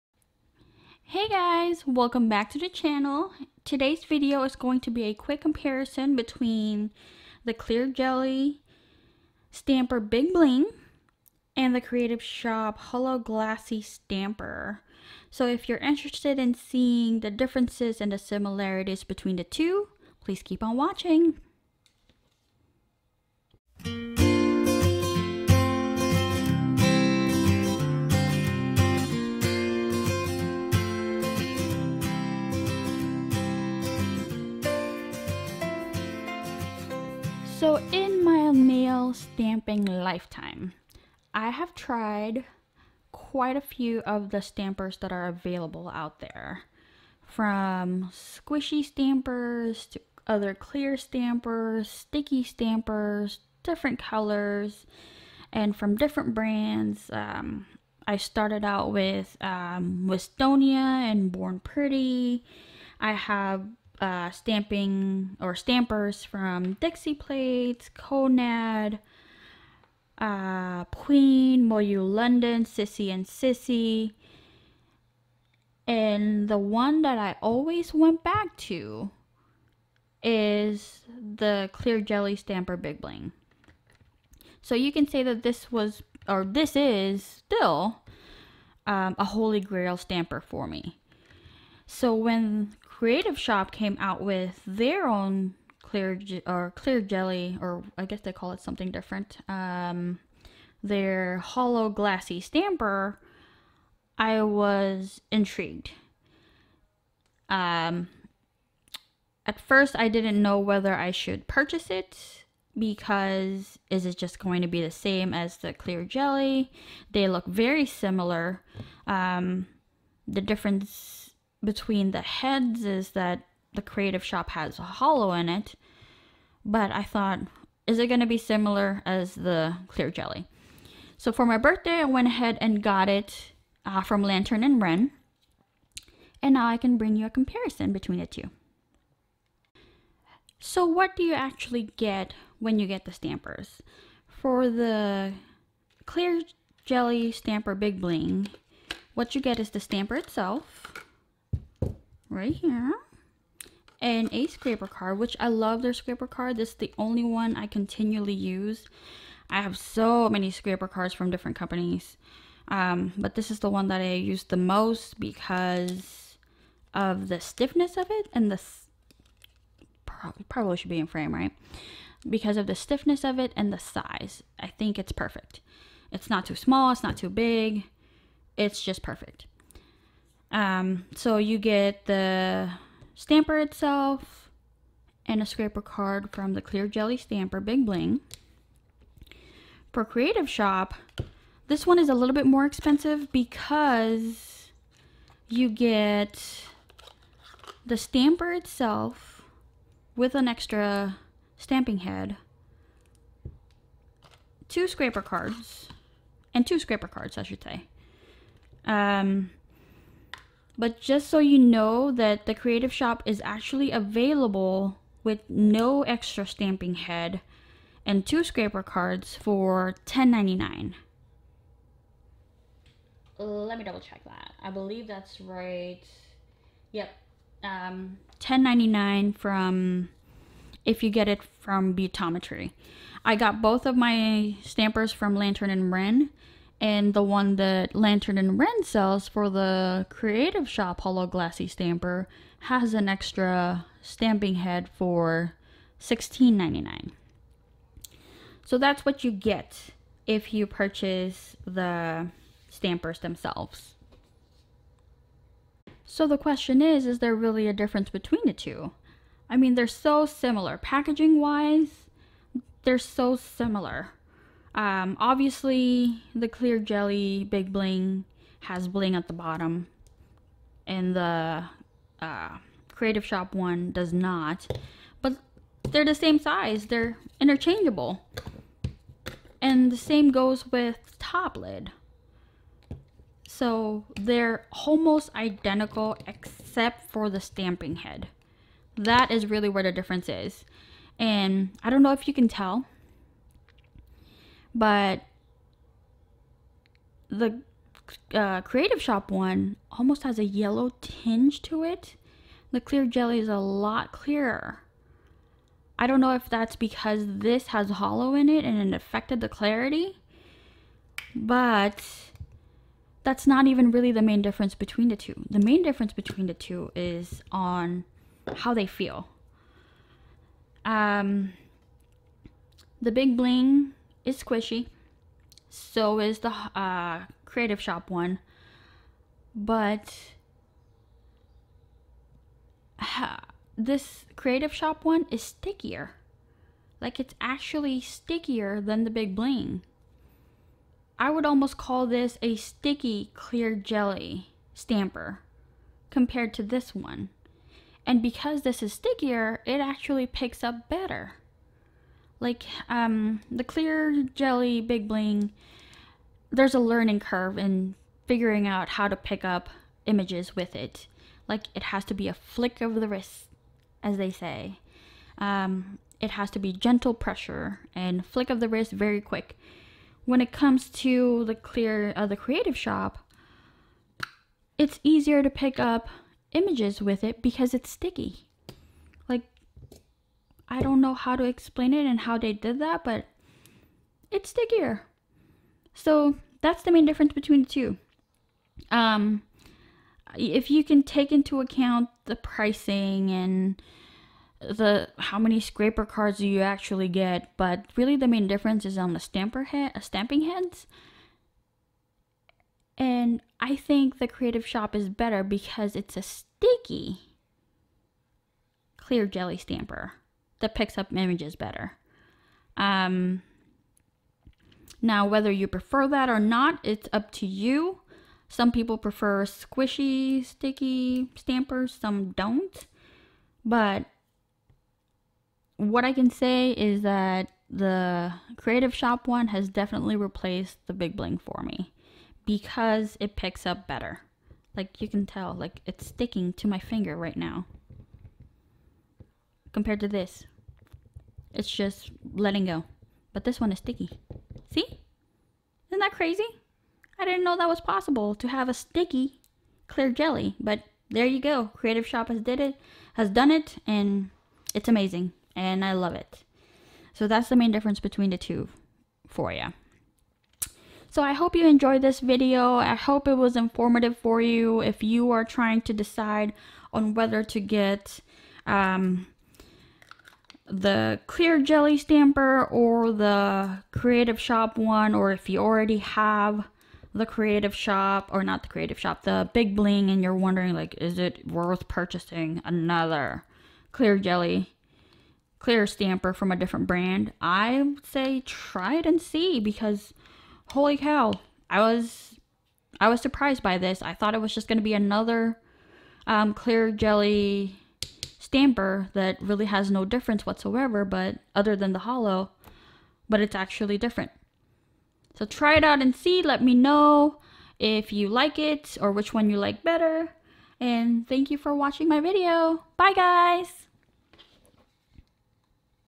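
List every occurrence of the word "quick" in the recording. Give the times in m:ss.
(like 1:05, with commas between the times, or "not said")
0:05, 6:09.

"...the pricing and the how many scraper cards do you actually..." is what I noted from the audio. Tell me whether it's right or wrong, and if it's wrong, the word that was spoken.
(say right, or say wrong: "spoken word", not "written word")
right.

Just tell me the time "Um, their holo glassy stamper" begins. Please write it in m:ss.
1:39.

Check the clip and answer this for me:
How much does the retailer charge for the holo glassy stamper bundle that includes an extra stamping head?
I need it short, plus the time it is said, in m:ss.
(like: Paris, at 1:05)
$16.99, at 4:06.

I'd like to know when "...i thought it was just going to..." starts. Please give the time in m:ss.
8:14.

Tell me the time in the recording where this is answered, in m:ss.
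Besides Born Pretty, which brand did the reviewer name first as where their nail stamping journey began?
1:00.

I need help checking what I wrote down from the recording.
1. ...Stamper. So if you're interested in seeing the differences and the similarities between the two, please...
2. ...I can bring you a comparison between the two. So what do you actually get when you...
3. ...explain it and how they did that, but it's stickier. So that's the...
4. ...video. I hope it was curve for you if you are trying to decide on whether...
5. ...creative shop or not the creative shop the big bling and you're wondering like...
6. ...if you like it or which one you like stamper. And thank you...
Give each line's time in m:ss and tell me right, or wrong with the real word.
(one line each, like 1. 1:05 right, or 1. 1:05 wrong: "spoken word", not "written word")
1. 0:13 right
2. 2:16 right
3. 6:21 right
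4. 7:42 wrong: "informative", not "curve"
5. 7:57 right
6. 8:27 wrong: "better", not "stamper".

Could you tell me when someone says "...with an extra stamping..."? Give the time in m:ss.
3:20.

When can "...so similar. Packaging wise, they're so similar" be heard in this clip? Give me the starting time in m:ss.
4:19.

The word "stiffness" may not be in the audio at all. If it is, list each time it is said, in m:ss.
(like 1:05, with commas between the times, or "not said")
2:47, 2:52.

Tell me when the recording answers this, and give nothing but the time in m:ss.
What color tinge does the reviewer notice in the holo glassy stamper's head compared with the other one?
5:00.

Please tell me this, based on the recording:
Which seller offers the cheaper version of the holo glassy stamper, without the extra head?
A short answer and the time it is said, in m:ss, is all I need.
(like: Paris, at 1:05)
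Butometry, at 3:51.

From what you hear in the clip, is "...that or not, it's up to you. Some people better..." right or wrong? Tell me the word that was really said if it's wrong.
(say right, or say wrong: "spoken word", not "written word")
wrong: "prefer", not "better".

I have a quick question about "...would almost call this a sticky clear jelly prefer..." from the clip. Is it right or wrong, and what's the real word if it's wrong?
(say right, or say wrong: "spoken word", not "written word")
wrong: "stamper", not "prefer".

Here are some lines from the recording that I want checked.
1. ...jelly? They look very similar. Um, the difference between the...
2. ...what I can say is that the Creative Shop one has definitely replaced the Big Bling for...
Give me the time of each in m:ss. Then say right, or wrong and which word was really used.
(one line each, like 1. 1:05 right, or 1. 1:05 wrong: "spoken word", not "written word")
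1. 1:56 right
2. 7:05 right.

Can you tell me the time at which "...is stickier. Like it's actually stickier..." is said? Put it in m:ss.
5:35.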